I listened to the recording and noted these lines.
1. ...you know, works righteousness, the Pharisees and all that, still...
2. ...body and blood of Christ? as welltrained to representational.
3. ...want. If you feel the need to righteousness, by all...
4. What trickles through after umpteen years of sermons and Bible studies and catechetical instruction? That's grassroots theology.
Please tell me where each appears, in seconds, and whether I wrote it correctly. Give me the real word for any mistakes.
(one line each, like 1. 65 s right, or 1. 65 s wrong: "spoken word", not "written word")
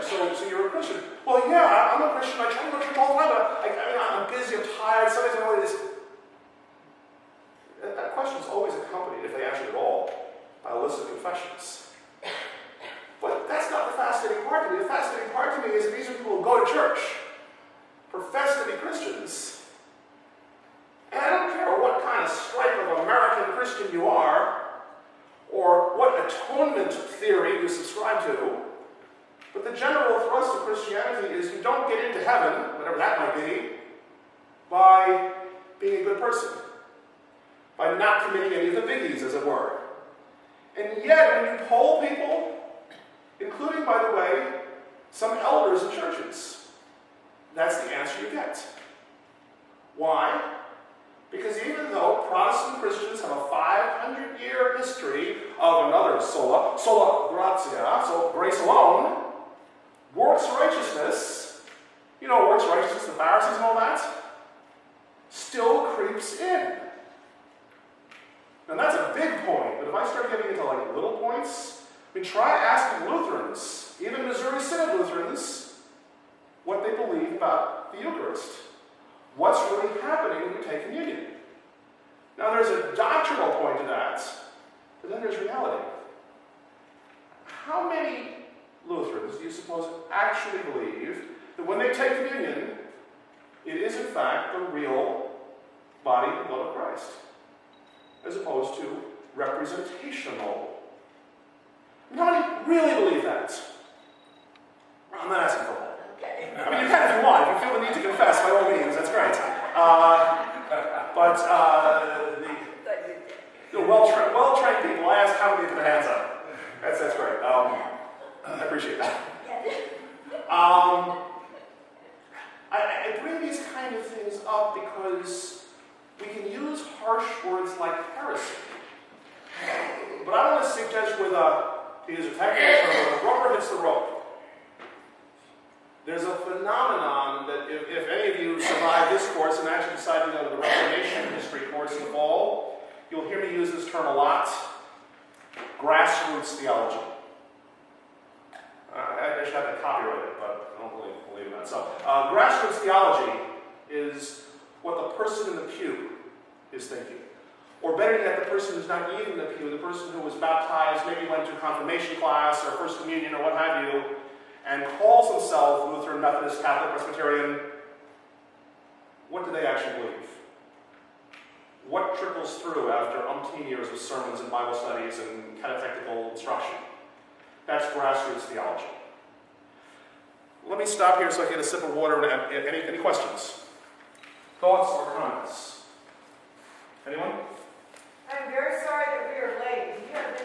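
1. 62 s right
2. 96 s wrong: "opposed", not "welltrained"
3. 107 s wrong: "confess", not "righteousness"
4. 171 s right.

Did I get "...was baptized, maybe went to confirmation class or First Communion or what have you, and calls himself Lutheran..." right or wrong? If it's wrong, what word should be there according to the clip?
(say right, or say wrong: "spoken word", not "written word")
right.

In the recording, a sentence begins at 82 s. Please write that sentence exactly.
Now there's a doctrinal point to that, but then there's reality.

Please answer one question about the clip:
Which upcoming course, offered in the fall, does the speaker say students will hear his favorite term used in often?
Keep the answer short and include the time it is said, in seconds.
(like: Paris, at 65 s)
Reformation history, at 140 s.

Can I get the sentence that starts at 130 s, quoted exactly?
But I want to suggest with a, uh, to use a technical term, rubber hits the road.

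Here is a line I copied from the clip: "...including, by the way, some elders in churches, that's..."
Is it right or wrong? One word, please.
right.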